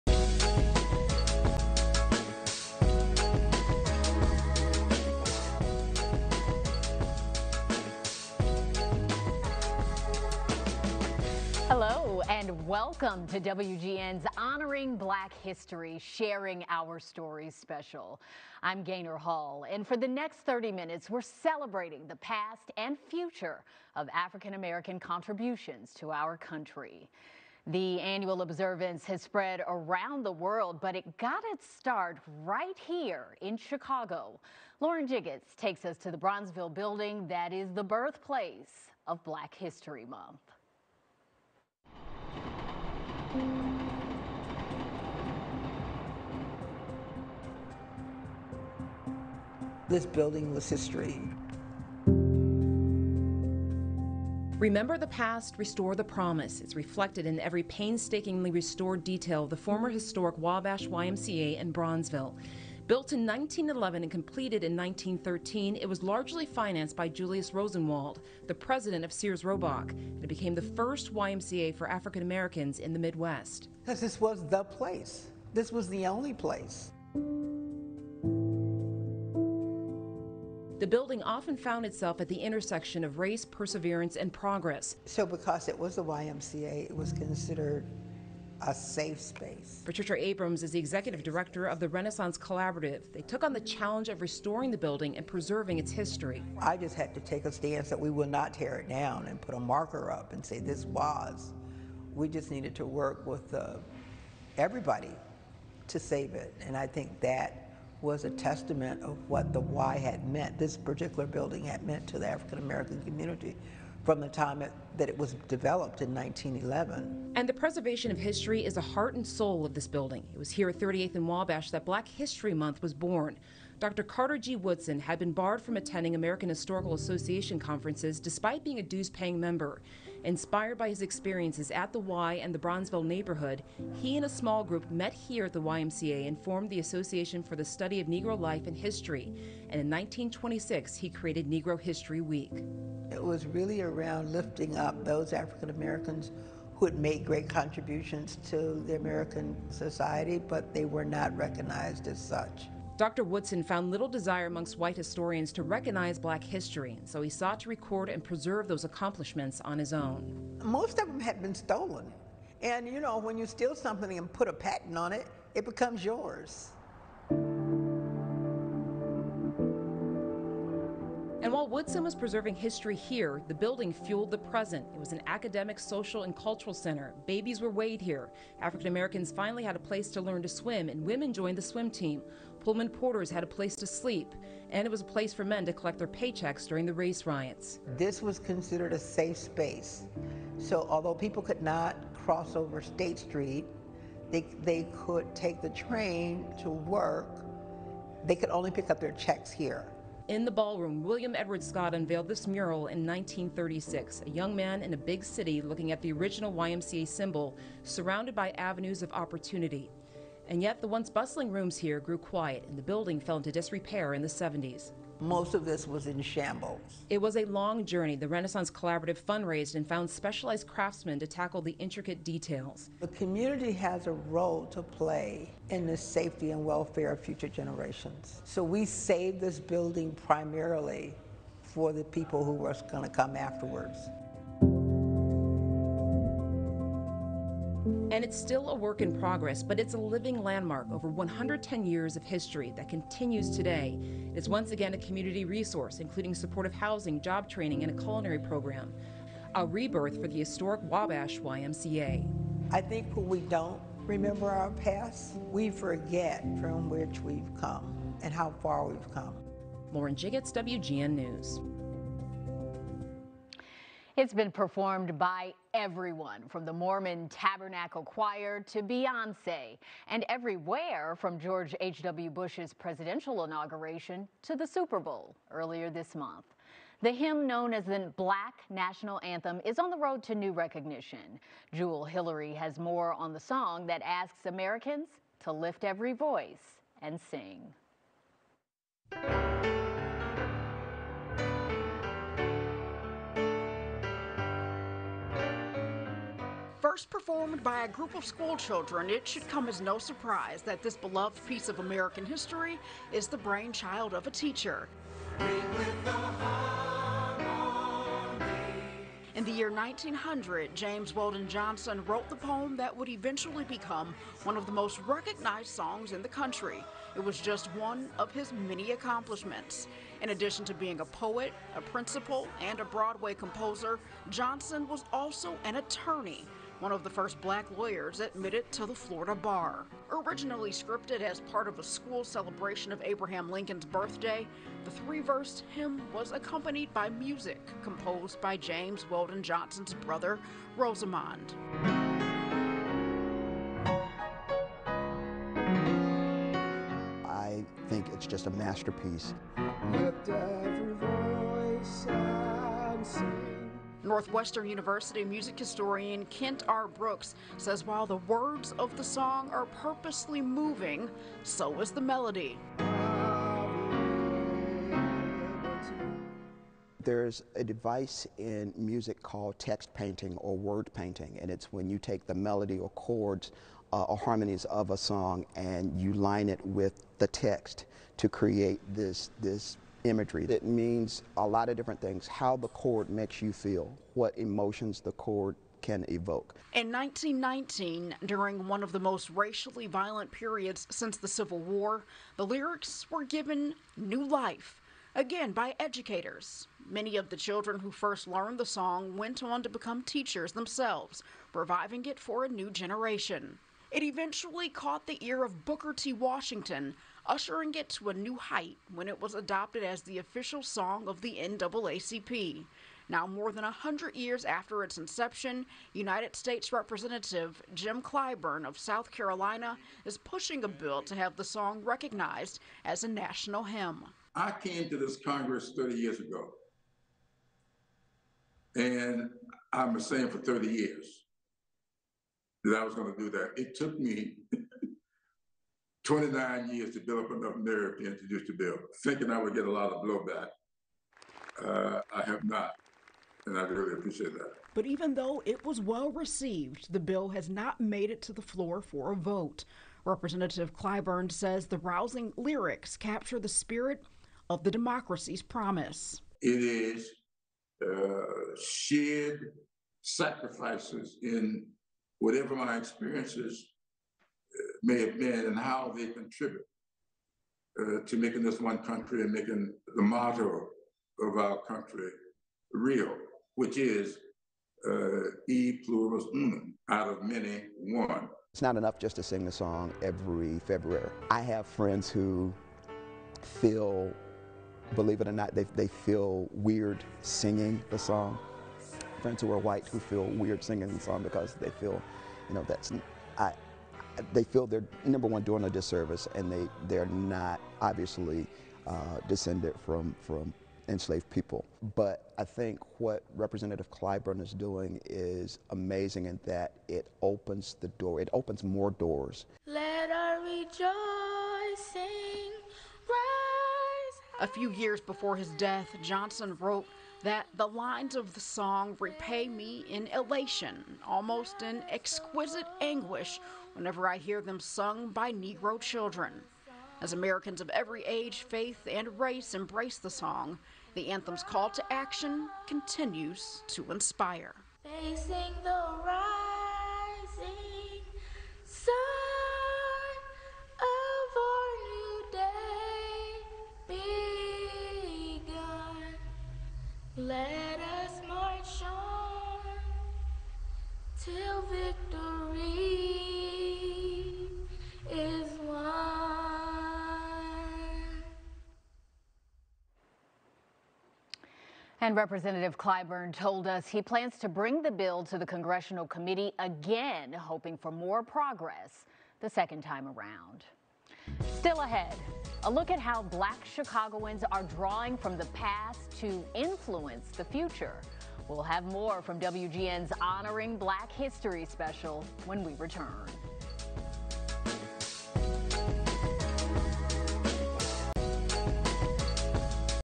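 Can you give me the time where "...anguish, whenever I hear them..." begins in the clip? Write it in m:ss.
8:42.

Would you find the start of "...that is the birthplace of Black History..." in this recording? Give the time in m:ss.
0:37.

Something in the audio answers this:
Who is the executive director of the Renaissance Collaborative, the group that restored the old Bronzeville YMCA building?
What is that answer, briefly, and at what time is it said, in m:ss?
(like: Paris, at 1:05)
Patricia Abrams, at 1:29.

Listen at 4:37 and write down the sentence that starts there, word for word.
The hymn known as the Black National Anthem is on the road to new recognition.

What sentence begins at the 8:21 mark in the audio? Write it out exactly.
But I think what Representative Clyburn is doing is amazing in that it opens the door, it opens more doors.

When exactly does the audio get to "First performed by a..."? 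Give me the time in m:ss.
4:56.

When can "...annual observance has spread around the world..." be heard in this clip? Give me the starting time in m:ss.
0:27.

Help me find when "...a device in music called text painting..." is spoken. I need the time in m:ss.
6:07.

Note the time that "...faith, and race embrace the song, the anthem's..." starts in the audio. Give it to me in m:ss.
8:48.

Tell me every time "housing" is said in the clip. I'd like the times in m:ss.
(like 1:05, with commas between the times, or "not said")
4:06.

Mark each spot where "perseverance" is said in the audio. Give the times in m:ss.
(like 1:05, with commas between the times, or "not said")
1:23.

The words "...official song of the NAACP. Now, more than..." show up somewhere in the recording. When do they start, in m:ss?
6:50.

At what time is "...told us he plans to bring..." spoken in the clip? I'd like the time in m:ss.
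9:23.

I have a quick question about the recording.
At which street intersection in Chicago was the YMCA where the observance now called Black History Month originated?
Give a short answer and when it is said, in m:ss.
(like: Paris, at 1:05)
38th and Wabash, at 2:00.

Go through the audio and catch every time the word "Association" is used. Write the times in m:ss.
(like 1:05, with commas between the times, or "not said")
2:06, 2:16.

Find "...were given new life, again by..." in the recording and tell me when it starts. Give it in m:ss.
6:33.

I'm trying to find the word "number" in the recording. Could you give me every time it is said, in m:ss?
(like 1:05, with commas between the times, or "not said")
8:15.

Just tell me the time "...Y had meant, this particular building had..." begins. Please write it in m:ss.
1:49.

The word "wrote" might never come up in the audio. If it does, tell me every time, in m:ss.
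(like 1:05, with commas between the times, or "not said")
5:12, 8:36.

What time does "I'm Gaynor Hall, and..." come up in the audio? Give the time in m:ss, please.
0:18.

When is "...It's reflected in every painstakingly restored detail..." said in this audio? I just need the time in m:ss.
0:56.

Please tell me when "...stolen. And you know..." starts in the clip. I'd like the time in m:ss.
2:41.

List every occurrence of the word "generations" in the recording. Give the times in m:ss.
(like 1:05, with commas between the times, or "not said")
3:47, 6:42.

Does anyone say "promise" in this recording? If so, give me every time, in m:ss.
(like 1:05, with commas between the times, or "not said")
0:56, 7:35.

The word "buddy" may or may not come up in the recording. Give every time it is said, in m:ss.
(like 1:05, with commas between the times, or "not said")
not said.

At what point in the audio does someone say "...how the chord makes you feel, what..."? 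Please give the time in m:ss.
6:22.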